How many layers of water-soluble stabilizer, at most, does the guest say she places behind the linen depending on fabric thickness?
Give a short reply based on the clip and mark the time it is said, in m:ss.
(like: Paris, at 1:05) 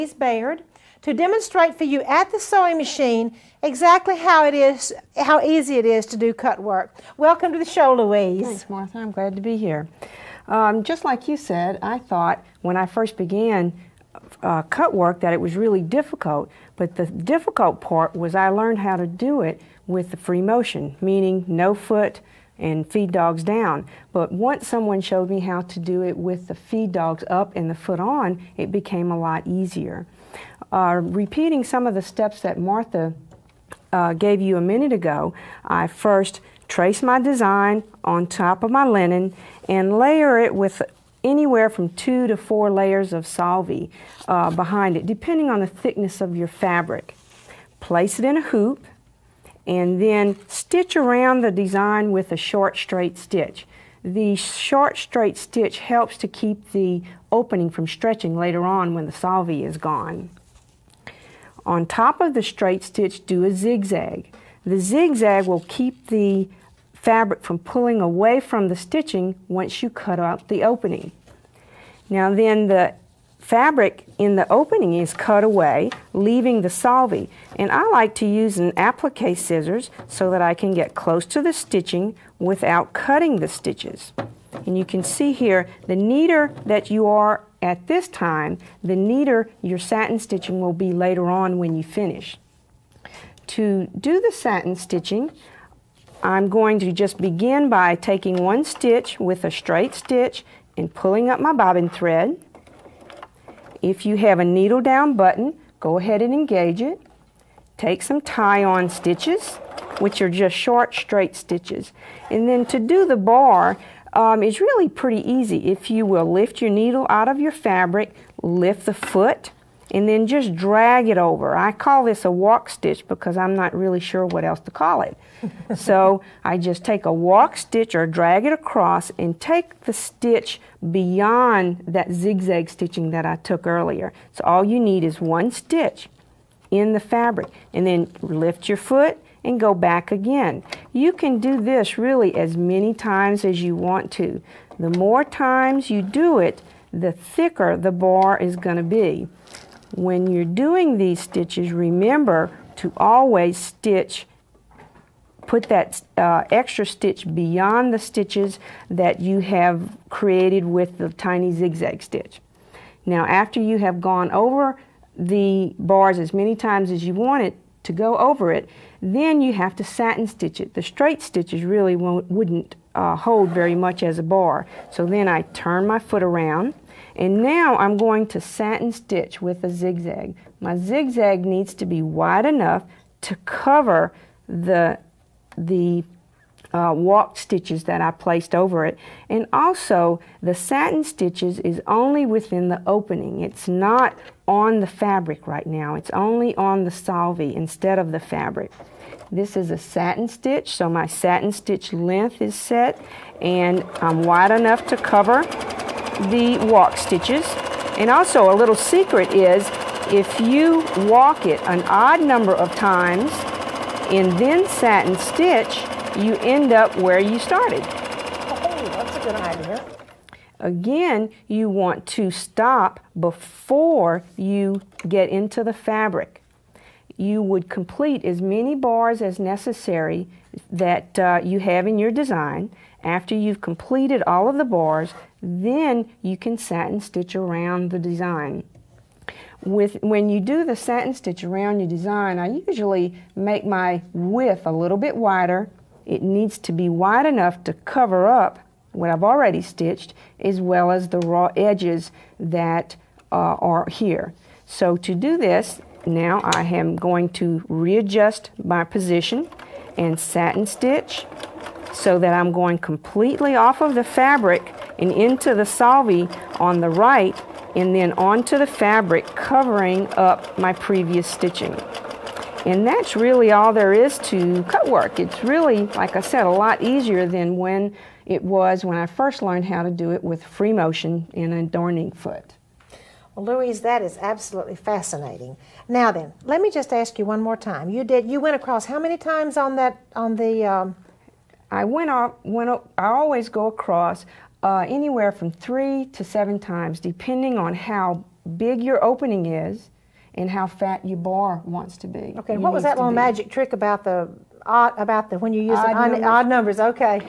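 4, at 0:41.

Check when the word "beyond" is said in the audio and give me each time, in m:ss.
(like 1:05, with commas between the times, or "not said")
2:10, 2:37.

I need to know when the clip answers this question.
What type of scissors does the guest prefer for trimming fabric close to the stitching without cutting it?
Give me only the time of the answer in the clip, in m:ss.
1:18.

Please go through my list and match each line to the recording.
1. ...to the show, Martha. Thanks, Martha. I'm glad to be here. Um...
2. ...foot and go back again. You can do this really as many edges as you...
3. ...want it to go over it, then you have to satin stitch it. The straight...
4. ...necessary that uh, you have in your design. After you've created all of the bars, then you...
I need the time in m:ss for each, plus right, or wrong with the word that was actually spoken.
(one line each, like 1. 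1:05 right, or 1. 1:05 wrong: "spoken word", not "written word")
1. 0:07 wrong: "Louise", not "Martha"
2. 2:18 wrong: "times", not "edges"
3. 2:47 right
4. 3:49 wrong: "completed", not "created".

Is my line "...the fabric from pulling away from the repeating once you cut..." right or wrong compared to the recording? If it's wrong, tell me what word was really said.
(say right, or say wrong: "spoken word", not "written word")
wrong: "stitching", not "repeating".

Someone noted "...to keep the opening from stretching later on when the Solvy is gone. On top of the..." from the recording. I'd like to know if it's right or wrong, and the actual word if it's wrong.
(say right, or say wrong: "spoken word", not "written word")
right.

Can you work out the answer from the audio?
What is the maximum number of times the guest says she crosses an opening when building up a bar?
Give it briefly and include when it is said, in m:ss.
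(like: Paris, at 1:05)
7, at 4:56.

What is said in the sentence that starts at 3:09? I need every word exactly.
And also, the satin stitches is only within the opening.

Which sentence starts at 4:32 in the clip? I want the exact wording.
And that's really all there is to cut work.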